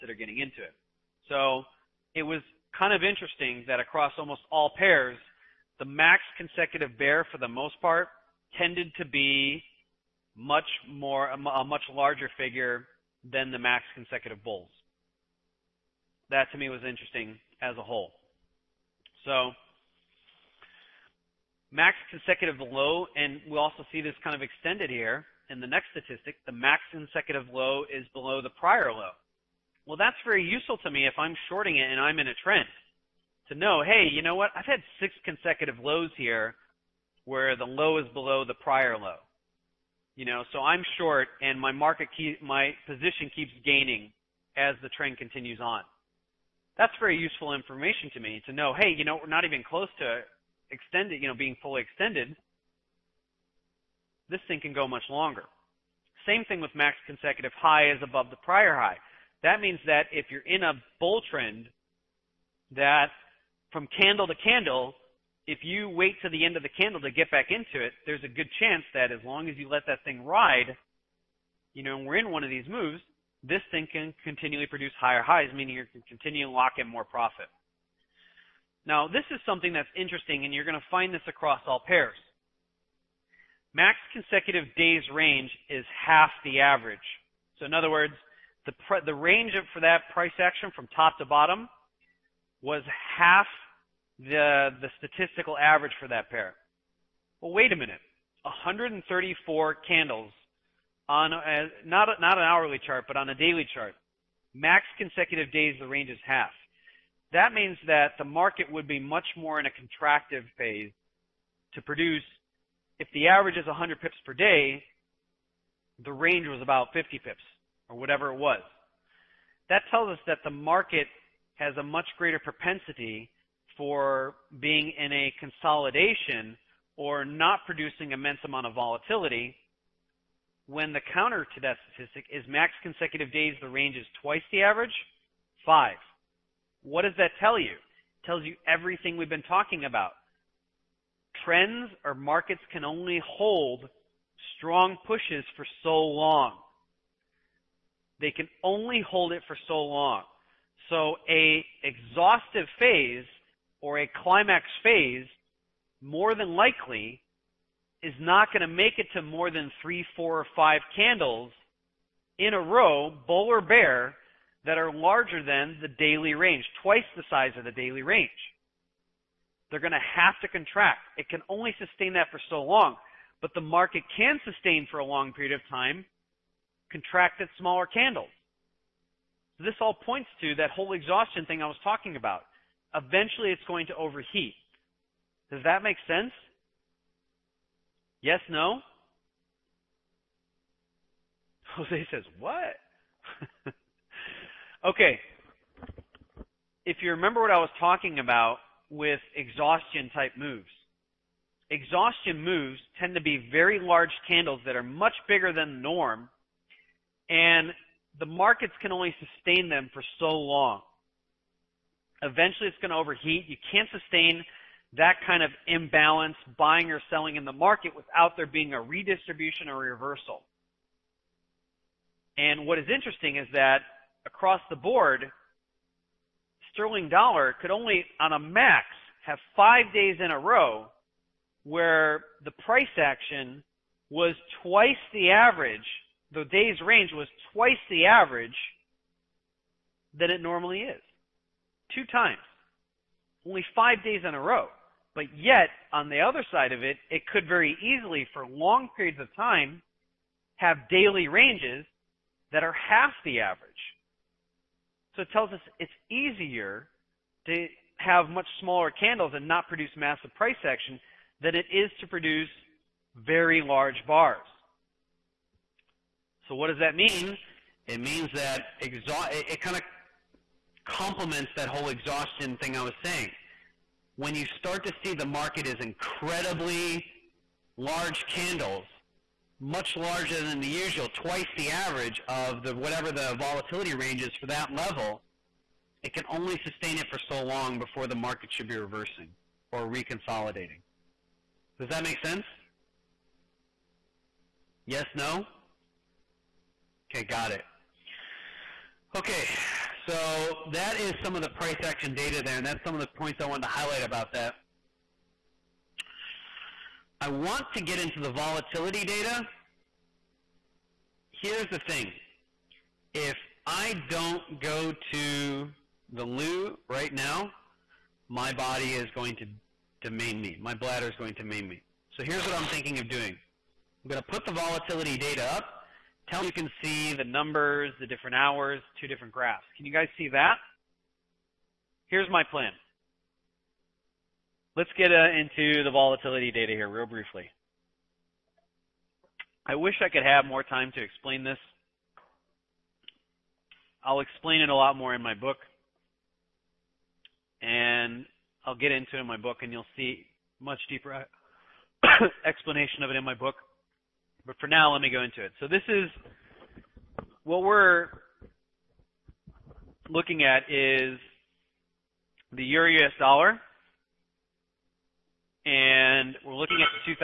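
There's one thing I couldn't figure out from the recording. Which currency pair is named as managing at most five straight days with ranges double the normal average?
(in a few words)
Sterling dollar.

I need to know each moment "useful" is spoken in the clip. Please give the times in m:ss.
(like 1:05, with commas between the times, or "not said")
0:30, 0:47.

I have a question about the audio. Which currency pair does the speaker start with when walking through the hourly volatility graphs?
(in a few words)
Euro US dollar.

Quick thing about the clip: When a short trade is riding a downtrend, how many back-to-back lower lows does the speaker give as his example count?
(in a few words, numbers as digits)
6.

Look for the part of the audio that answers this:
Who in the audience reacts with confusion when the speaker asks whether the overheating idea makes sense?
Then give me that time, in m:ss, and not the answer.
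3:11.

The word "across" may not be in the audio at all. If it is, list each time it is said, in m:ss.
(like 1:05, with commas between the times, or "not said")
0:03, 1:21, 3:44.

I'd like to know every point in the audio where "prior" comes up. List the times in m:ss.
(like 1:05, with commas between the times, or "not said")
0:28, 0:38, 0:58.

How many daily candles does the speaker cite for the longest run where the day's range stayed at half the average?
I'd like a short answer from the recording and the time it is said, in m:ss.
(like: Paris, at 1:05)
134, at 1:38.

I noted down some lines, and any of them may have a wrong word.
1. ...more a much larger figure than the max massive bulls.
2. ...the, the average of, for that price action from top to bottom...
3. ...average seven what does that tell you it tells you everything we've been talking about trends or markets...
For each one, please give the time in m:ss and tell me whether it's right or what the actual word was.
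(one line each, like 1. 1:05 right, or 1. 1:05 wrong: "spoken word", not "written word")
1. 0:10 wrong: "consecutive", not "massive"
2. 1:28 wrong: "range", not "average"
3. 2:14 wrong: "five", not "seven".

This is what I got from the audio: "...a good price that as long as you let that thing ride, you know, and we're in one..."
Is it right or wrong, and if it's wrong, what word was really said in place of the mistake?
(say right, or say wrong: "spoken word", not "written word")
wrong: "chance", not "price".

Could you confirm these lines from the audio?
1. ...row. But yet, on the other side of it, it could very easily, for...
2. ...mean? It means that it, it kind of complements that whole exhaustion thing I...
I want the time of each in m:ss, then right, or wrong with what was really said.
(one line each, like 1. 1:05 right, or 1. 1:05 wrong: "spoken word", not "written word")
1. 4:04 right
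2. 4:26 right.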